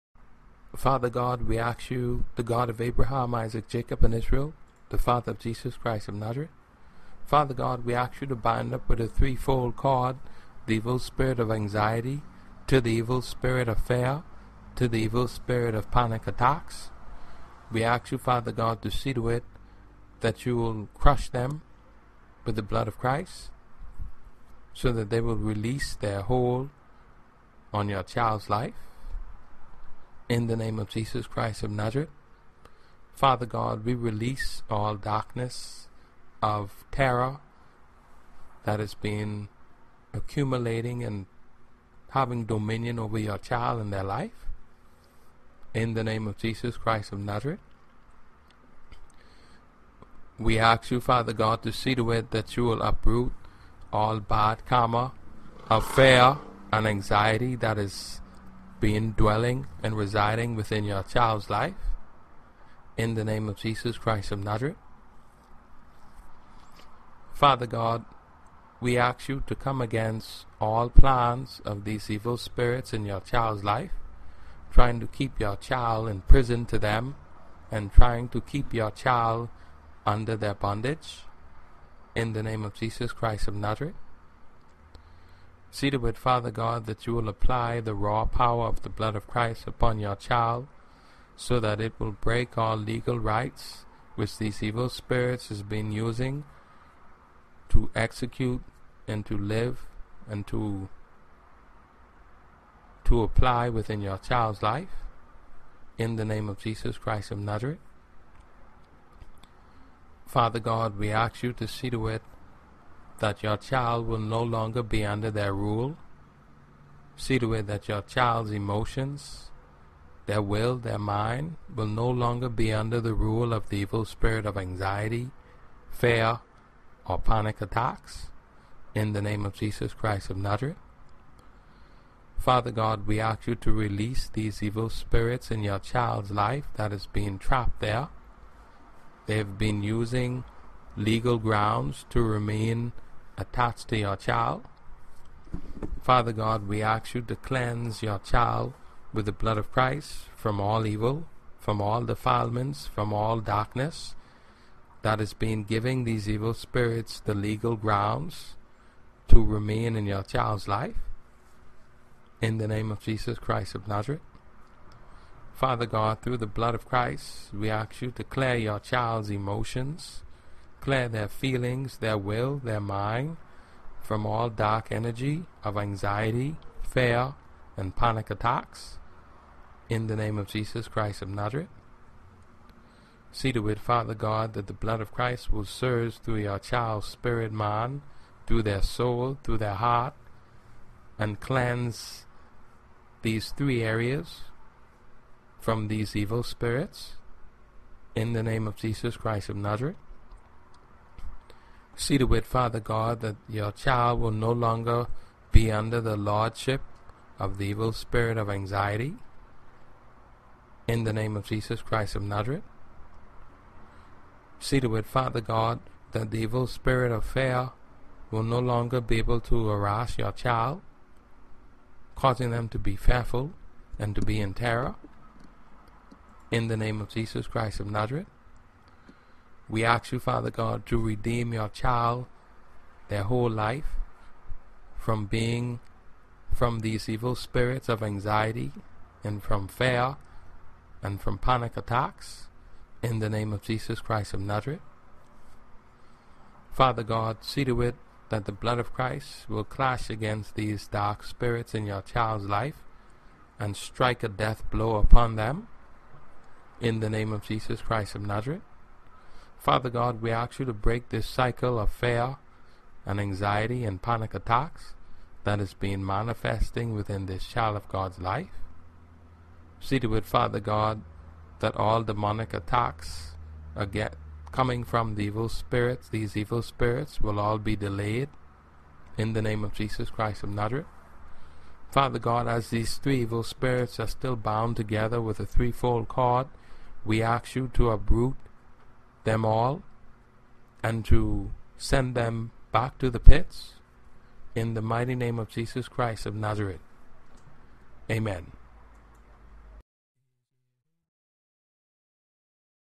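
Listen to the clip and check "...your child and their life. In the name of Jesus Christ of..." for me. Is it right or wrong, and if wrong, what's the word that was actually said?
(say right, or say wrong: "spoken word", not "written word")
right.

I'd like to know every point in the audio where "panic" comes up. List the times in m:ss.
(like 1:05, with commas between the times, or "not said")
0:15, 2:07, 2:57, 4:01, 4:24.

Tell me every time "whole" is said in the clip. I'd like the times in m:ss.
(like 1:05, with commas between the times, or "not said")
3:53.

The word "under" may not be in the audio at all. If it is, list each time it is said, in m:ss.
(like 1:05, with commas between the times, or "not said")
1:20, 1:55, 2:02, 3:25.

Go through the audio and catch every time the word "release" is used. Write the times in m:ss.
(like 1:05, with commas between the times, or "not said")
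0:25, 0:33, 2:13.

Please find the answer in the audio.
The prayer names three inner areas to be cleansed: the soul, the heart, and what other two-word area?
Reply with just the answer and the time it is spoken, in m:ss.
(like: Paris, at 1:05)
spirit man, at 3:07.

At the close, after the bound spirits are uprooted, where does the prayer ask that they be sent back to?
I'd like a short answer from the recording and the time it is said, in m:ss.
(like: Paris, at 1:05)
the pits, at 4:53.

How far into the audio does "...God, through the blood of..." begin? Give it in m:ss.
2:45.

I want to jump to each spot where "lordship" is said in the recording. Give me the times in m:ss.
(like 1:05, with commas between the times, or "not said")
3:26.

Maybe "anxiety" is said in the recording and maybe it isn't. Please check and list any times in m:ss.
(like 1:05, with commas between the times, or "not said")
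0:11, 0:56, 2:04, 2:55, 3:28, 3:58, 4:23.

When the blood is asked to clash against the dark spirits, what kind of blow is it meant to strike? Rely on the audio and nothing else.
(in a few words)
death blow.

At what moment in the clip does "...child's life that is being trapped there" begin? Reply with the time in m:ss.
2:15.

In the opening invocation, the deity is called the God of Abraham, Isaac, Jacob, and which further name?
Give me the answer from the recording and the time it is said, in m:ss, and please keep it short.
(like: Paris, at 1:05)
Israel, at 0:04.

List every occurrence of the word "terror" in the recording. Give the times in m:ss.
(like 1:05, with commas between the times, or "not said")
0:36, 3:44.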